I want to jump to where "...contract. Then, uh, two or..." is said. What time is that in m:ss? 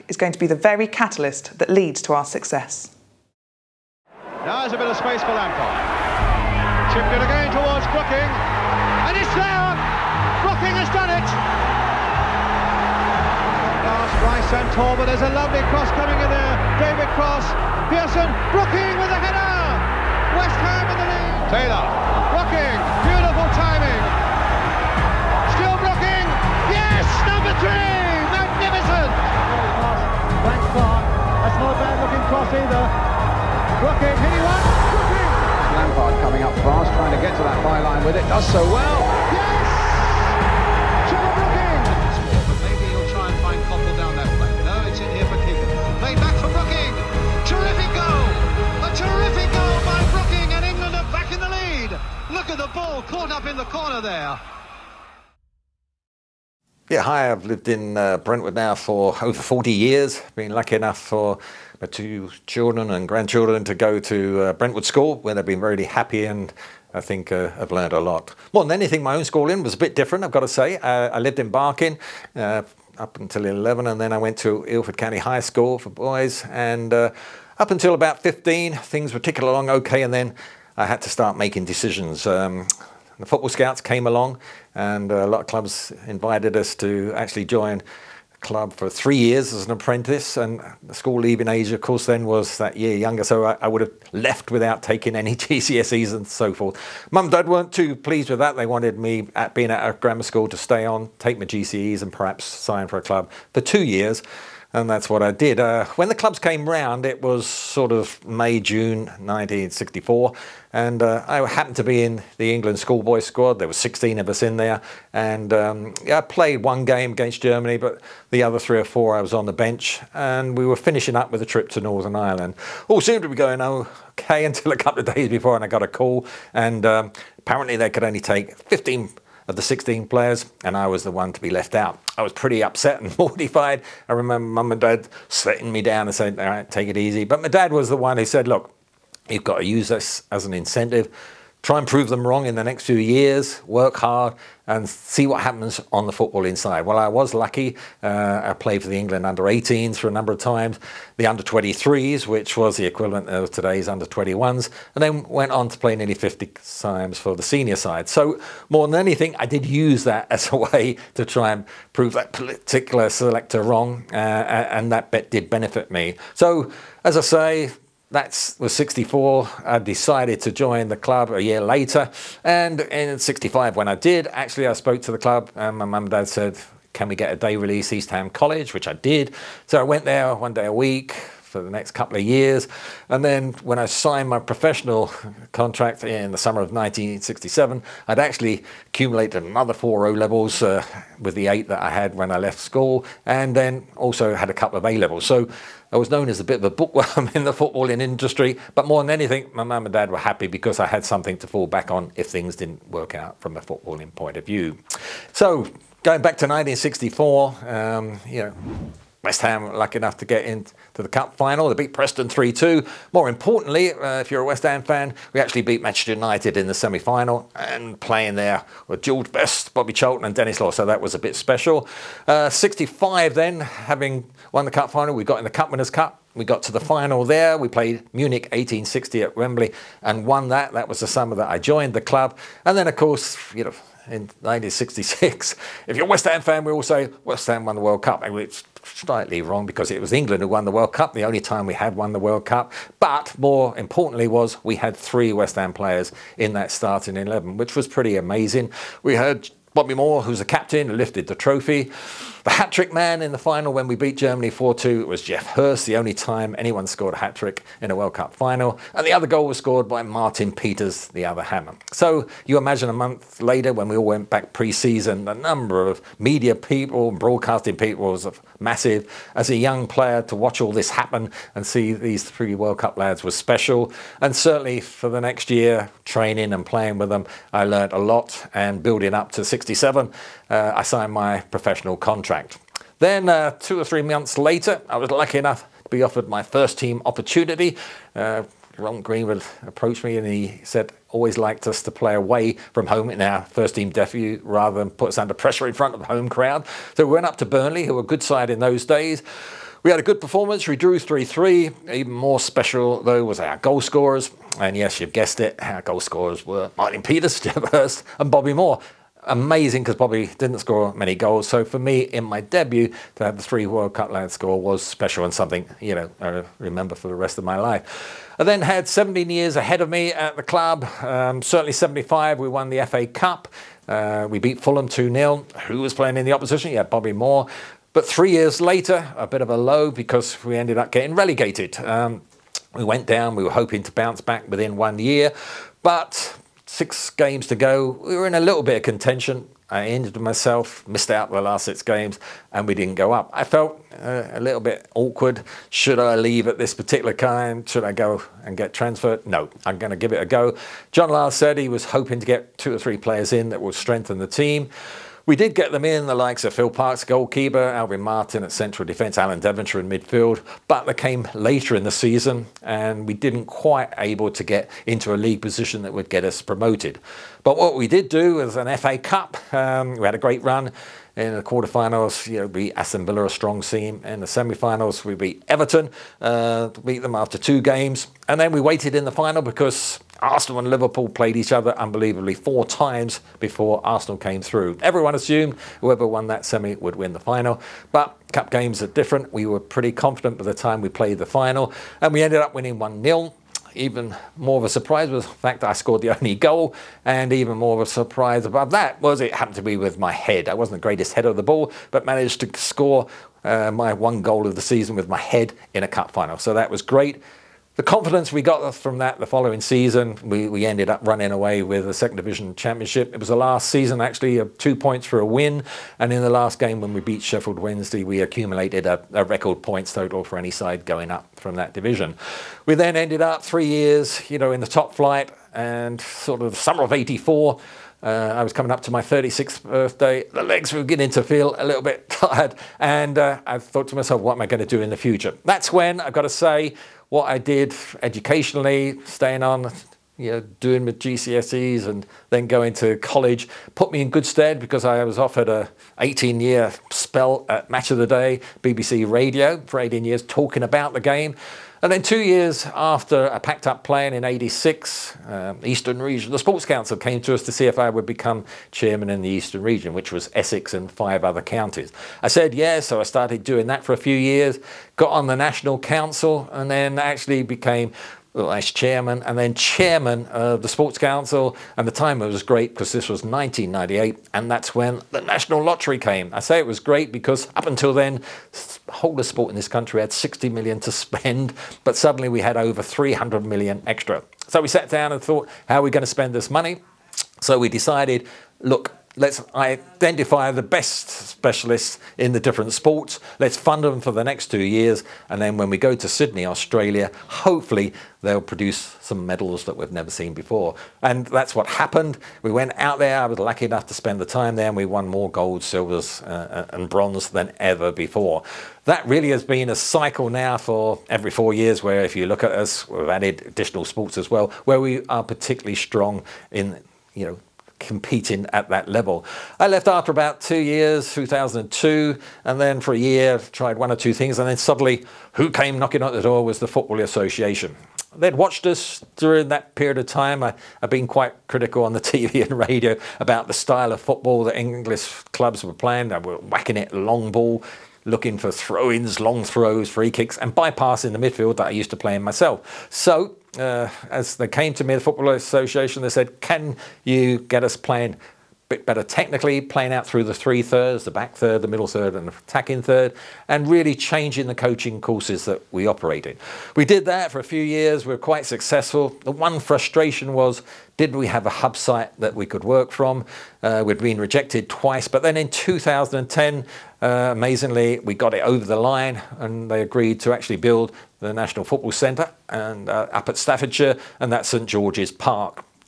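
4:42.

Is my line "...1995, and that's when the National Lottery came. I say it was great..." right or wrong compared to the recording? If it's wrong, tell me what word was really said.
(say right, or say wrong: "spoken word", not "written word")
wrong: "1998", not "1995".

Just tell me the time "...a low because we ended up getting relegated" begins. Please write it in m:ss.
5:29.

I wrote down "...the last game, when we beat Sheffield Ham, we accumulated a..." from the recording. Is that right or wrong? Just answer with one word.
wrong.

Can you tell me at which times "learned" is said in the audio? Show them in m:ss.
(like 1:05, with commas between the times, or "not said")
1:07, 4:37.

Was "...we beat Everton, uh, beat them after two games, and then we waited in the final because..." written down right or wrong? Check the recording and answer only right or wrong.
right.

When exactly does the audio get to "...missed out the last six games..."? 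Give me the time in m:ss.
5:40.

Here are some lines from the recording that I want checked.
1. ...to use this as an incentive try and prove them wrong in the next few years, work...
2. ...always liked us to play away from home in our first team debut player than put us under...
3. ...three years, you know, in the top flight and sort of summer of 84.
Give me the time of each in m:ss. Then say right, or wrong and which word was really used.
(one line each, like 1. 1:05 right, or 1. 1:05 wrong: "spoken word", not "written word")
1. 2:19 right
2. 4:51 wrong: "rather", not "player"
3. 7:03 right.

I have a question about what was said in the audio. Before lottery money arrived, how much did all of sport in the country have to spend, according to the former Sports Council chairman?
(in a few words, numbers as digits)
60 million.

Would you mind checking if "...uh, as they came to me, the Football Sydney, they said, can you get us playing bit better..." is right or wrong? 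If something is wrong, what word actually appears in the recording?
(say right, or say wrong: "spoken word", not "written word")
wrong: "Association", not "Sydney".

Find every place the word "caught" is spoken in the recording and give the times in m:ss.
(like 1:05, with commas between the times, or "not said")
0:53.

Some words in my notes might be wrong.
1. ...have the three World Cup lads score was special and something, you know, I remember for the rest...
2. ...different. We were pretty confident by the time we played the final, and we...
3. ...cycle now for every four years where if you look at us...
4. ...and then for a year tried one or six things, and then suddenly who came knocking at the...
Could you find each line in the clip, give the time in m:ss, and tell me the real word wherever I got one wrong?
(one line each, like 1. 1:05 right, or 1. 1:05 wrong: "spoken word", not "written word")
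1. 5:13 right
2. 6:28 right
3. 8:29 right
4. 8:42 wrong: "two", not "six".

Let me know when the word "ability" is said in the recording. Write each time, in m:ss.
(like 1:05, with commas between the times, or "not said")
not said.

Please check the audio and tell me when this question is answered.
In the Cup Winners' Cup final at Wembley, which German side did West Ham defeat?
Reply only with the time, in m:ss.
3:48.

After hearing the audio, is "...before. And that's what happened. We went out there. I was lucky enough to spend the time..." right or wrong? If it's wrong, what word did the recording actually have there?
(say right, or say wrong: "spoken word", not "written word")
right.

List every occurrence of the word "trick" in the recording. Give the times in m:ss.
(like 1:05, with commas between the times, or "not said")
4:12, 4:17.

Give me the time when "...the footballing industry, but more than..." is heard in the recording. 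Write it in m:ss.
3:17.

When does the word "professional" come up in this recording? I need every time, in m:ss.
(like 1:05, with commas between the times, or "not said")
3:04, 4:41.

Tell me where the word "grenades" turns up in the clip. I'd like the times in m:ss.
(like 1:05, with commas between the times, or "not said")
not said.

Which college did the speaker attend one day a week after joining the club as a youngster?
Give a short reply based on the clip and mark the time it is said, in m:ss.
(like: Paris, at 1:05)
East Ham College, at 2:57.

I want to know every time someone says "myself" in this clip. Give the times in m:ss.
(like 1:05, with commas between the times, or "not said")
5:40, 7:13, 9:02.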